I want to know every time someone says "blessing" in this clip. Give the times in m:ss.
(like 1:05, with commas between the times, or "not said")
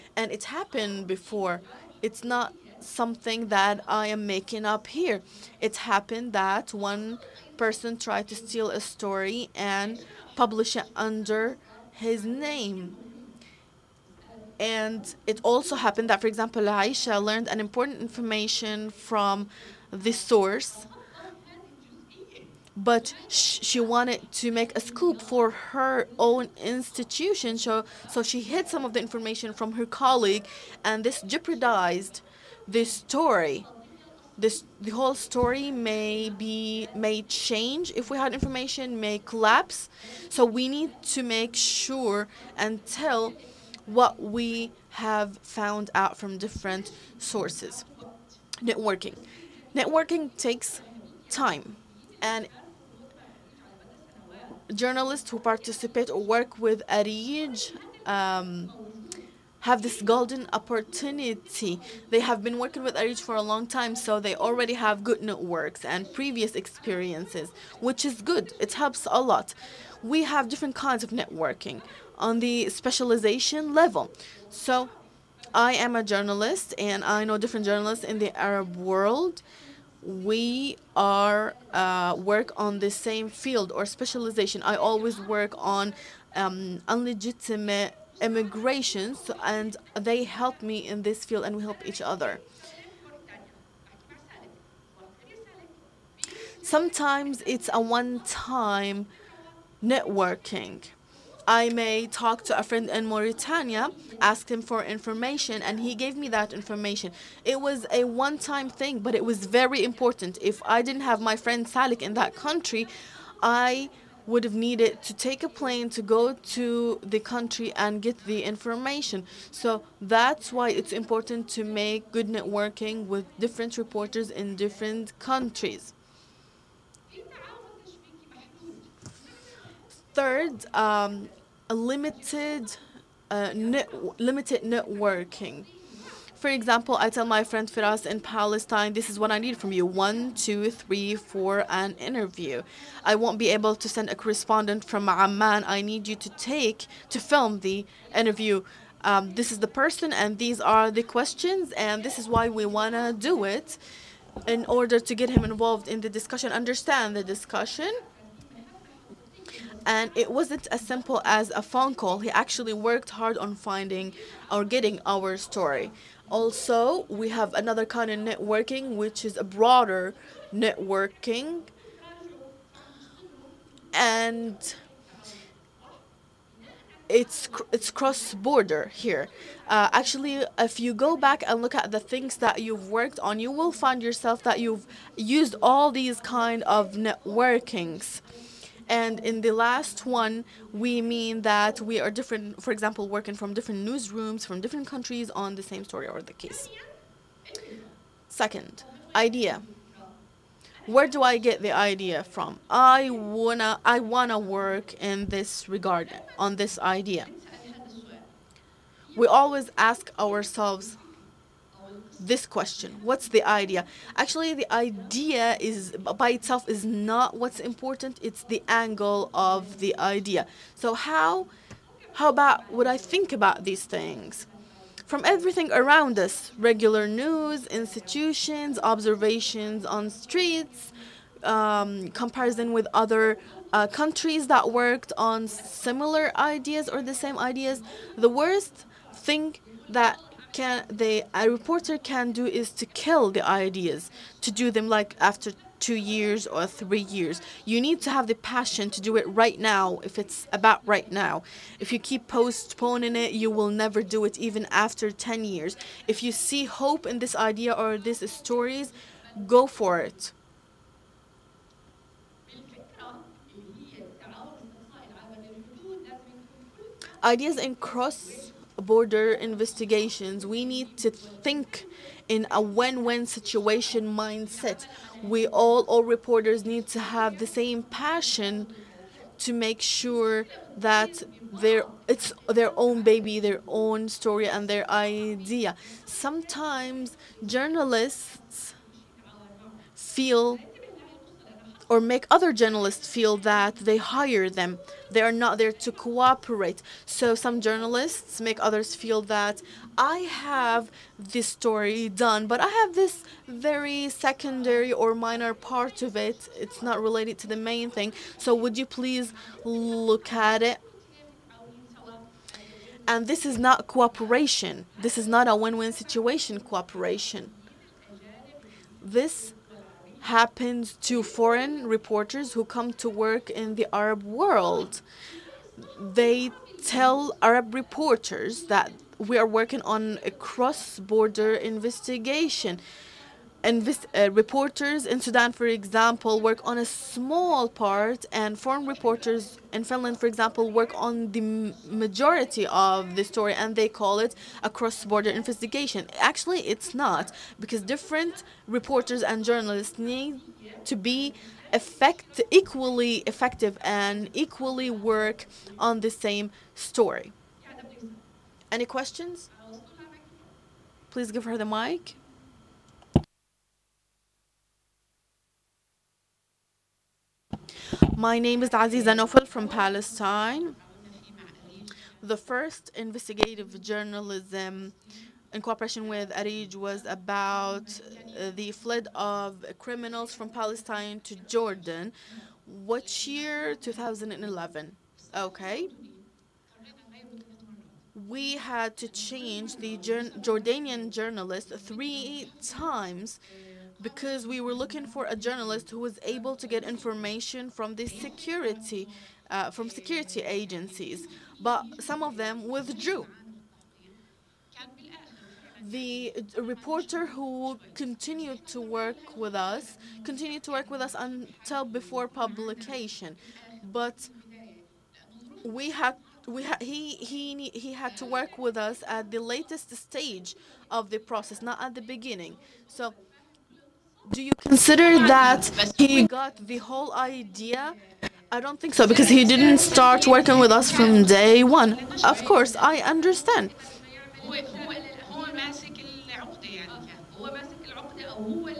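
not said.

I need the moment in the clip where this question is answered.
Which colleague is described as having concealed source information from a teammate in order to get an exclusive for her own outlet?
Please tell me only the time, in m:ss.
0:16.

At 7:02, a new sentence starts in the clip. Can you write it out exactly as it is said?
So do you consider that he got the whole idea?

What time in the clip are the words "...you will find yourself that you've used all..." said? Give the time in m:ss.
3:03.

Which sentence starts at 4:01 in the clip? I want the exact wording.
a reporter can do is to kill the ideas, to do them like after two years or three years.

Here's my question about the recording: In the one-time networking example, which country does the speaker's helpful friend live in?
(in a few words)
Mauritania.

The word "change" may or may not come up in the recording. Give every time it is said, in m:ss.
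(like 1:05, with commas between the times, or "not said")
0:37, 6:29.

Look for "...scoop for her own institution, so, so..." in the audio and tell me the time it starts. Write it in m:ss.
0:24.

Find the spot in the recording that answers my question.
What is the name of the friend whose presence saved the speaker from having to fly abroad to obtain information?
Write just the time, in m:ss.
1:51.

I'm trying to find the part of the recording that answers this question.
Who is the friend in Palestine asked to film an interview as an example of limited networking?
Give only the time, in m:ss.
2:17.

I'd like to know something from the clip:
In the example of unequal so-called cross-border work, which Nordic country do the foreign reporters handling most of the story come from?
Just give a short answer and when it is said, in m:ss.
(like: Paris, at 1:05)
Finland, at 5:39.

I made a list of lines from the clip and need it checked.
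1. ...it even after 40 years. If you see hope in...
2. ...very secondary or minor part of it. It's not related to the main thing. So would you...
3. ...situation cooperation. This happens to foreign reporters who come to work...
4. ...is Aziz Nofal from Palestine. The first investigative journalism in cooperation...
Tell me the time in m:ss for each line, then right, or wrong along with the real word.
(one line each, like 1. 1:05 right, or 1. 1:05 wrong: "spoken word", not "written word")
1. 4:14 wrong: "10", not "40"
2. 5:03 right
3. 5:15 right
4. 6:08 right.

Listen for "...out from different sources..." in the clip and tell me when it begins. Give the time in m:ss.
0:45.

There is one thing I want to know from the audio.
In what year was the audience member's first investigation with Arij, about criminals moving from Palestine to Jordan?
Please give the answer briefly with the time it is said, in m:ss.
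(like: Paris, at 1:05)
2011, at 6:23.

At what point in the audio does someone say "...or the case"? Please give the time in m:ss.
3:16.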